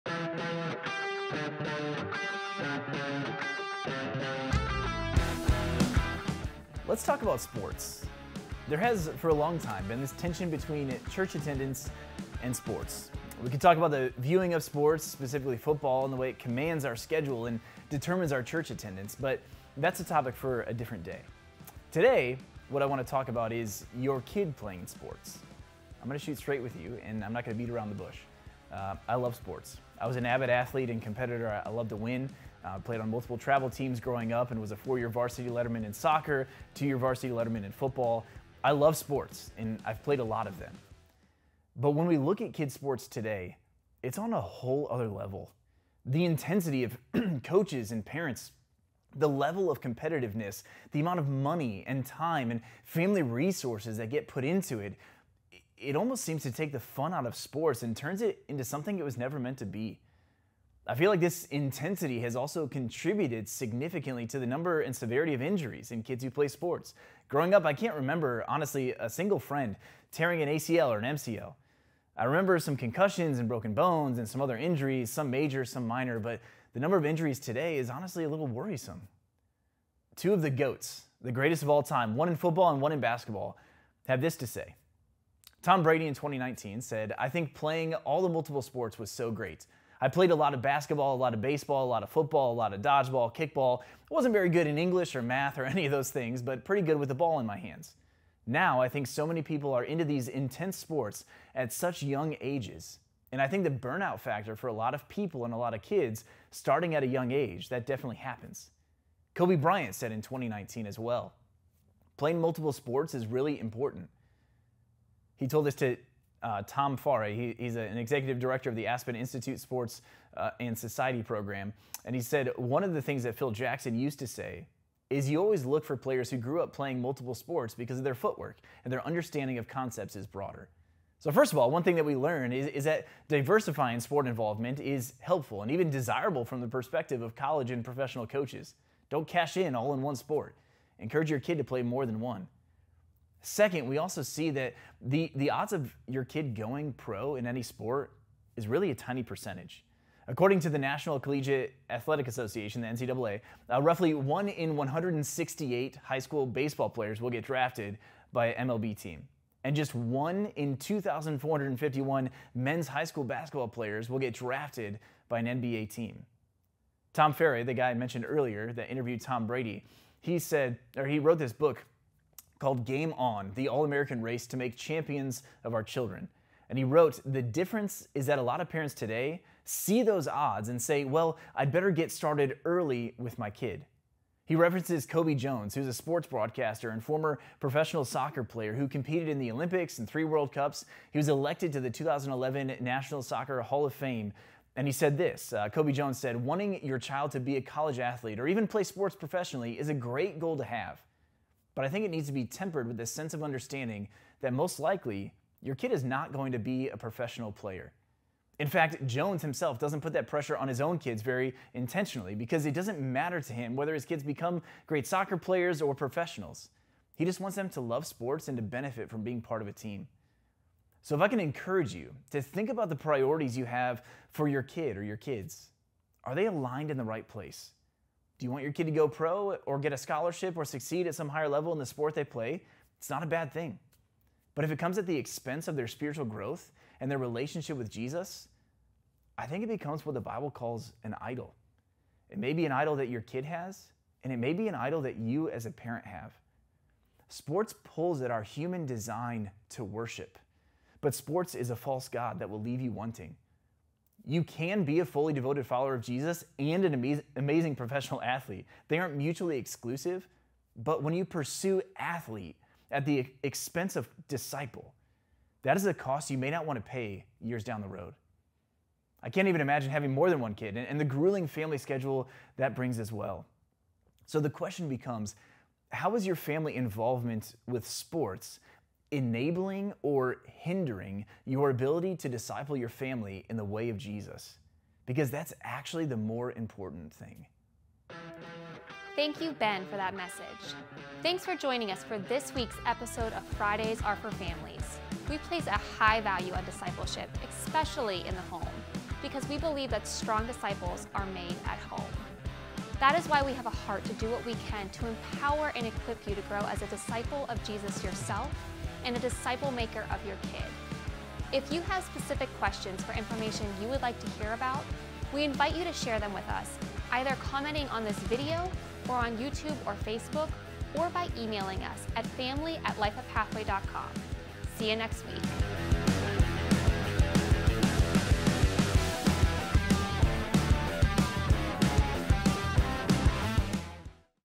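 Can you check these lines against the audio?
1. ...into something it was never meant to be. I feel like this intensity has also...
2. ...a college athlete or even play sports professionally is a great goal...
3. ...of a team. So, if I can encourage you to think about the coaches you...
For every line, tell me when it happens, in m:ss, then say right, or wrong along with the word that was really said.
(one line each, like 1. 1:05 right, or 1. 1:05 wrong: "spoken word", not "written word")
1. 0:58 right
2. 3:17 right
3. 3:39 wrong: "priorities", not "coaches".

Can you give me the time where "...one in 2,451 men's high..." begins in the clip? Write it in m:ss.
2:39.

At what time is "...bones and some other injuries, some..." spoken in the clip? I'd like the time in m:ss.
1:13.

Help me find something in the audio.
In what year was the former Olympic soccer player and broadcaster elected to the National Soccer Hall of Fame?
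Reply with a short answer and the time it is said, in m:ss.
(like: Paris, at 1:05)
2011, at 3:11.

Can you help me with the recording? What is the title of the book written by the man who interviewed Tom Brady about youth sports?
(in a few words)
Game On.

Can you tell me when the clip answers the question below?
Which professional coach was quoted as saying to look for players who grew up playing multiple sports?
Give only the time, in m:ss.
2:03.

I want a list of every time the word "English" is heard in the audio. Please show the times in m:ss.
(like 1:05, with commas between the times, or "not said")
1:34.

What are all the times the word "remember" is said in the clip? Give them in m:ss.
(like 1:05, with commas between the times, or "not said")
1:07, 1:12.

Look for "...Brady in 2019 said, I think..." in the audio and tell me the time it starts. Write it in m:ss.
1:25.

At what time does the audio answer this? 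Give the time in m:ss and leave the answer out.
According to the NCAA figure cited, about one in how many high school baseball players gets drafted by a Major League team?
2:34.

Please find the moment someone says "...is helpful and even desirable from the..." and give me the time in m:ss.
2:14.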